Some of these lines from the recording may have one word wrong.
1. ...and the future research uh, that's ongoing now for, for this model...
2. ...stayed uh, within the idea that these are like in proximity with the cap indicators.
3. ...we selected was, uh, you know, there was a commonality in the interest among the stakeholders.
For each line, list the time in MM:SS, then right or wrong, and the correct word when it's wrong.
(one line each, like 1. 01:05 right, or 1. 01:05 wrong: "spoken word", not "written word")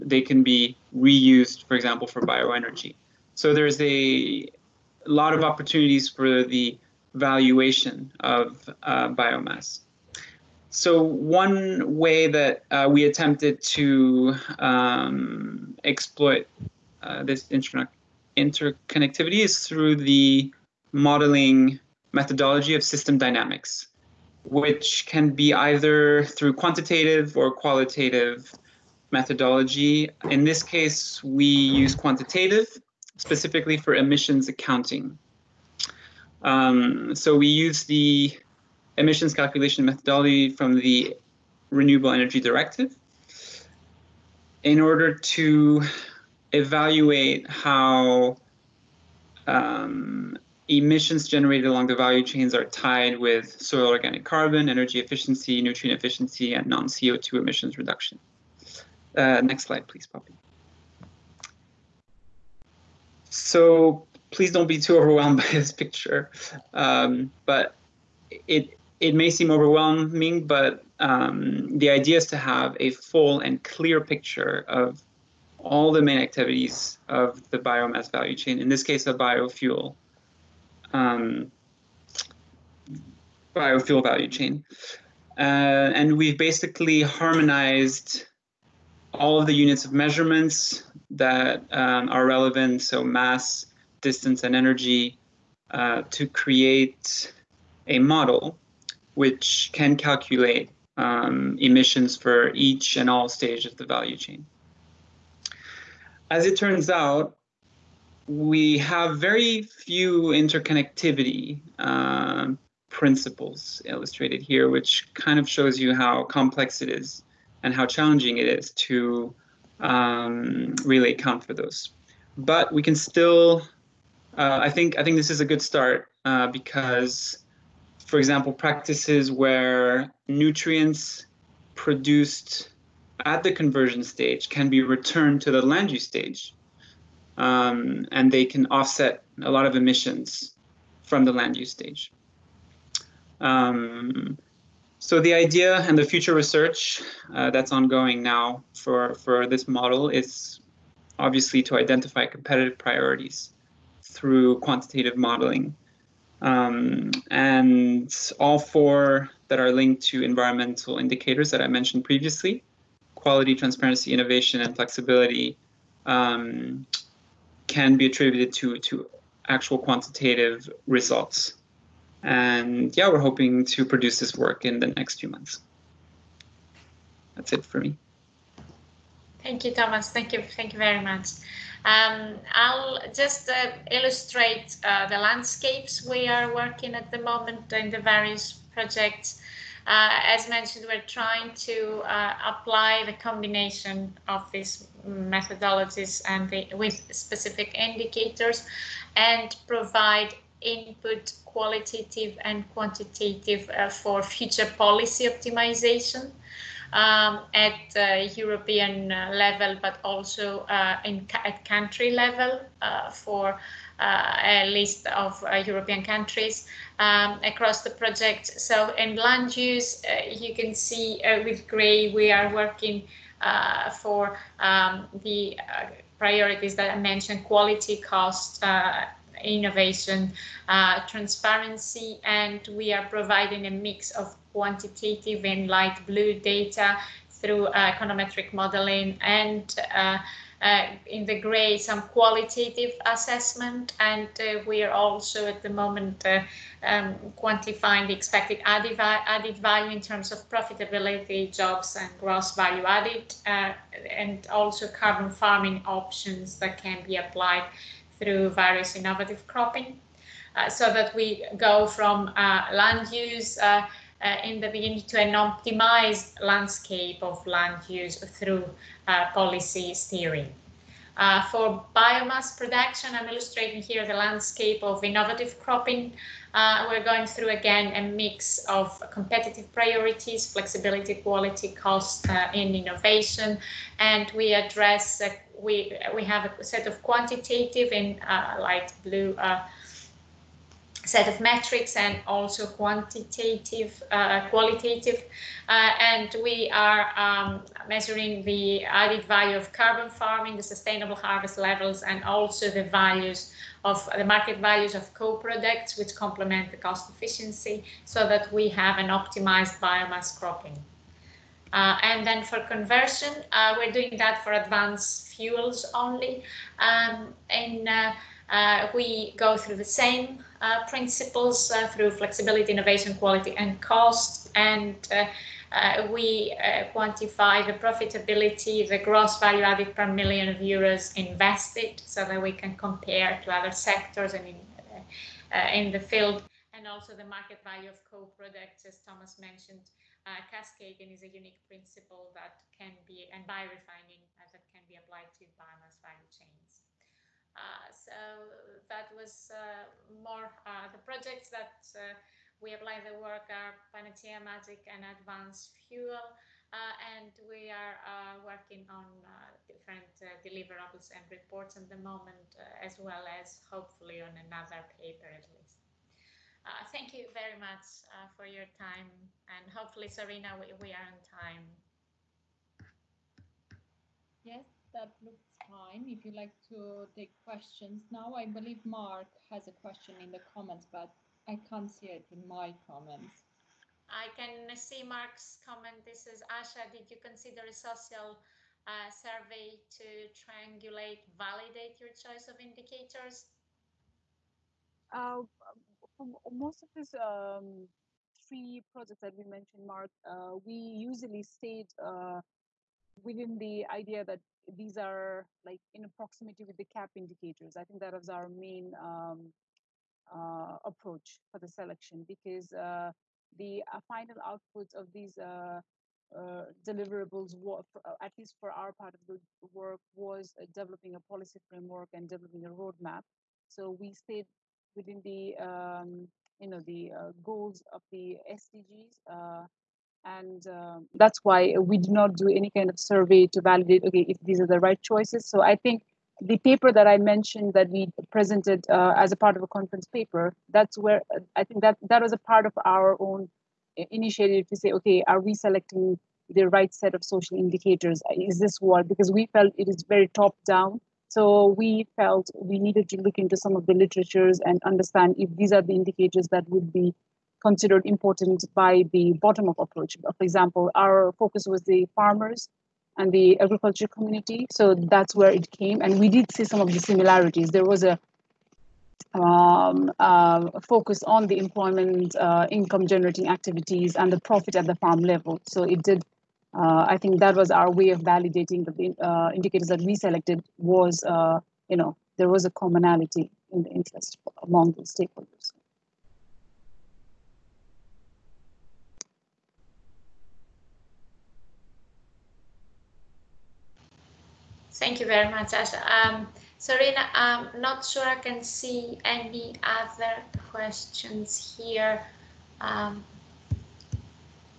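1. 02:25 right
2. 06:41 right
3. 08:00 right.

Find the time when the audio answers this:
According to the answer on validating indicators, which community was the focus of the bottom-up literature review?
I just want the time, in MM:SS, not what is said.
07:42.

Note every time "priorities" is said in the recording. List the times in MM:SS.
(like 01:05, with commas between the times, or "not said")
02:32, 03:46, 04:39.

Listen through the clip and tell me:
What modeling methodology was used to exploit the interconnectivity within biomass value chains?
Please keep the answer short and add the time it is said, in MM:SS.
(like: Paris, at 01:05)
system dynamics, at 00:22.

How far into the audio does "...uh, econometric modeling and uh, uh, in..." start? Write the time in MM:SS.
03:57.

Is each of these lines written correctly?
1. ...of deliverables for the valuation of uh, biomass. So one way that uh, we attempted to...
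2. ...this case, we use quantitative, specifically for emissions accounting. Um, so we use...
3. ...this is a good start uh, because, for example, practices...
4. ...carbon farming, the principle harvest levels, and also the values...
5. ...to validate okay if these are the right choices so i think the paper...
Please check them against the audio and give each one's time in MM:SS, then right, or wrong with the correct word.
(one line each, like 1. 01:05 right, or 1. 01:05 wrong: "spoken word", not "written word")
1. 00:05 wrong: "opportunities", not "deliverables"
2. 00:30 right
3. 02:05 right
4. 04:59 wrong: "sustainable", not "principle"
5. 07:13 right.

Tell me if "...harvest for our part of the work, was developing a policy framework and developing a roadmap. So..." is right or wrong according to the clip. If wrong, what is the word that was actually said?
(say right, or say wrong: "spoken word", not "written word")
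wrong: "least", not "harvest".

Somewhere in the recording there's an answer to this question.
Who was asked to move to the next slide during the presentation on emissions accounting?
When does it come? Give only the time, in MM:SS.
01:00.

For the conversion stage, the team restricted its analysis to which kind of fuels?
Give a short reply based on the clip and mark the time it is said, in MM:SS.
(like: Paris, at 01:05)
advanced fuels, at 05:14.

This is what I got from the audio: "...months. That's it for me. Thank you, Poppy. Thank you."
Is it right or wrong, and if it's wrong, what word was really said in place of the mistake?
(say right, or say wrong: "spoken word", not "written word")
wrong: "Thomas", not "Poppy".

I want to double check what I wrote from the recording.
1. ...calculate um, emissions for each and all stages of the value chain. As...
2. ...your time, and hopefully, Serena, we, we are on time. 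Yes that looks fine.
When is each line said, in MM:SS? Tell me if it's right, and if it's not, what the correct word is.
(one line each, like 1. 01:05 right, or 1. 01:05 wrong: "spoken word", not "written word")
1. 01:39 right
2. 06:08 right.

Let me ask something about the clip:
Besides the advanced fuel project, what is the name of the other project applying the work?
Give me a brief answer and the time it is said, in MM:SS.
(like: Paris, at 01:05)
Magic, at 05:54.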